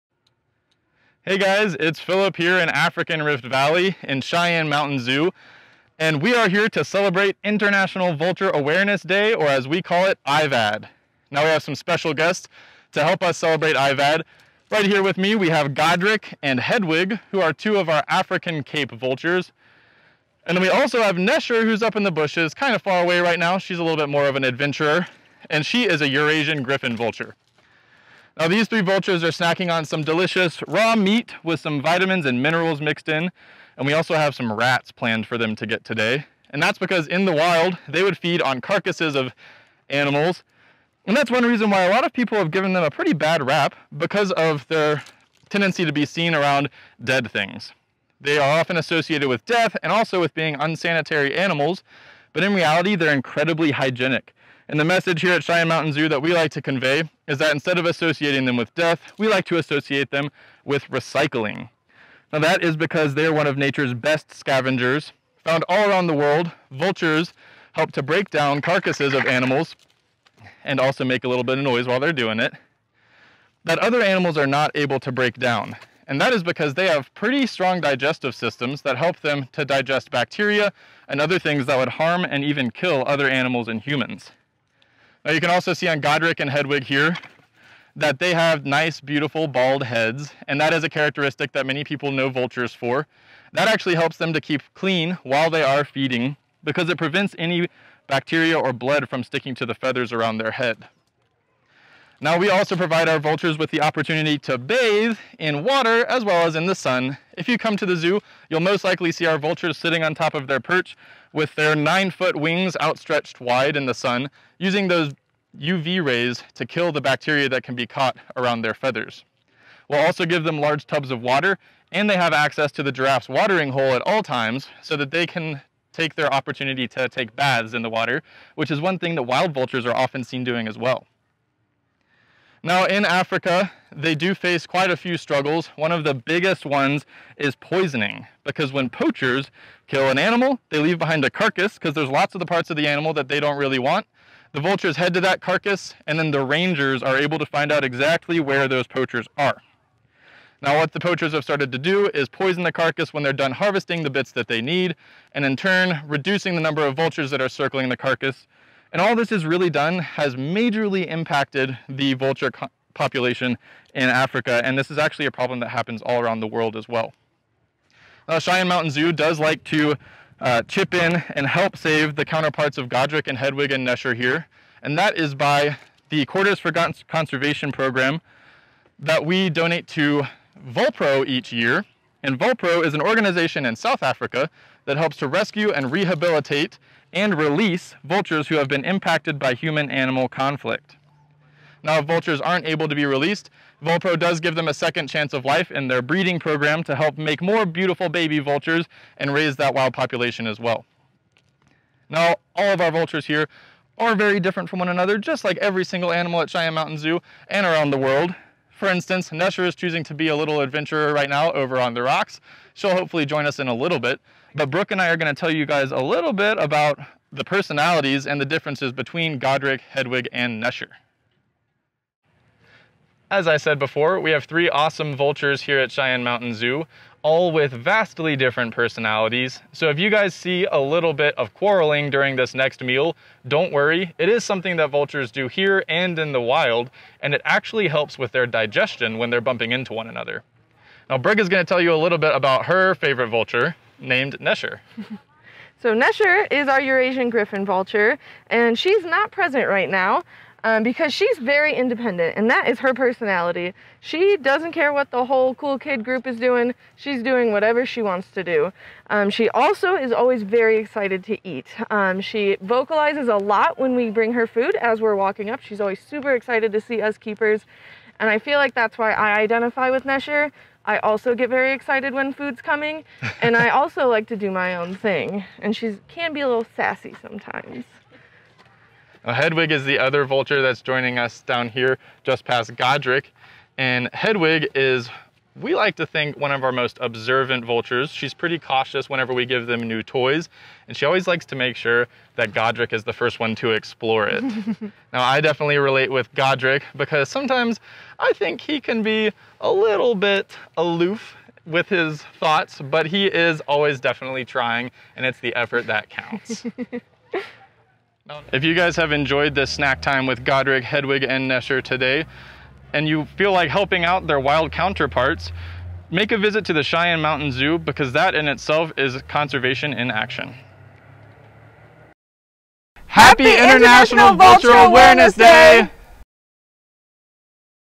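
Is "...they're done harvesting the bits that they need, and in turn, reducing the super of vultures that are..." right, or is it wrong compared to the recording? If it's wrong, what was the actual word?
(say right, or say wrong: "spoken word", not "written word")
wrong: "number", not "super".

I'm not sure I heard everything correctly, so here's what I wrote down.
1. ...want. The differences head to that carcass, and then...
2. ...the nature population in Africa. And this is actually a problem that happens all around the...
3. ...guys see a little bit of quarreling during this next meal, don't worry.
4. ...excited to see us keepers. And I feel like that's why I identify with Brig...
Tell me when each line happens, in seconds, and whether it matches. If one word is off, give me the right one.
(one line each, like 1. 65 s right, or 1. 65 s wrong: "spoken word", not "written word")
1. 143 s wrong: "vultures", not "differences"
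2. 161 s wrong: "vulture", not "nature"
3. 230 s right
4. 266 s wrong: "Nesher", not "Brig".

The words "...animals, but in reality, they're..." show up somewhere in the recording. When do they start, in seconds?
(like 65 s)
51 s.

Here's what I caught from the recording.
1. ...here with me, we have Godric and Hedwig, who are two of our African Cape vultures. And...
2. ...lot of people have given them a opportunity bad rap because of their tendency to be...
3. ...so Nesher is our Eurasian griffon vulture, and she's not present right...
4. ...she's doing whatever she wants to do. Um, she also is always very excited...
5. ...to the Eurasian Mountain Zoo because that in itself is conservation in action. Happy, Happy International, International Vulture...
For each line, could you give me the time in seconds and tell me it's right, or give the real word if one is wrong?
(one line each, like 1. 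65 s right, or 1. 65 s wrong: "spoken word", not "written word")
1. 14 s right
2. 41 s wrong: "pretty", not "opportunity"
3. 245 s right
4. 256 s right
5. 316 s wrong: "Cheyenne", not "Eurasian".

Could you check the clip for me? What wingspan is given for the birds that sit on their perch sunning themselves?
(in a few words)
9 feet.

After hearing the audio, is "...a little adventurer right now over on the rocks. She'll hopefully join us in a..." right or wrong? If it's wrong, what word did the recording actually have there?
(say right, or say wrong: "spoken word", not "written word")
right.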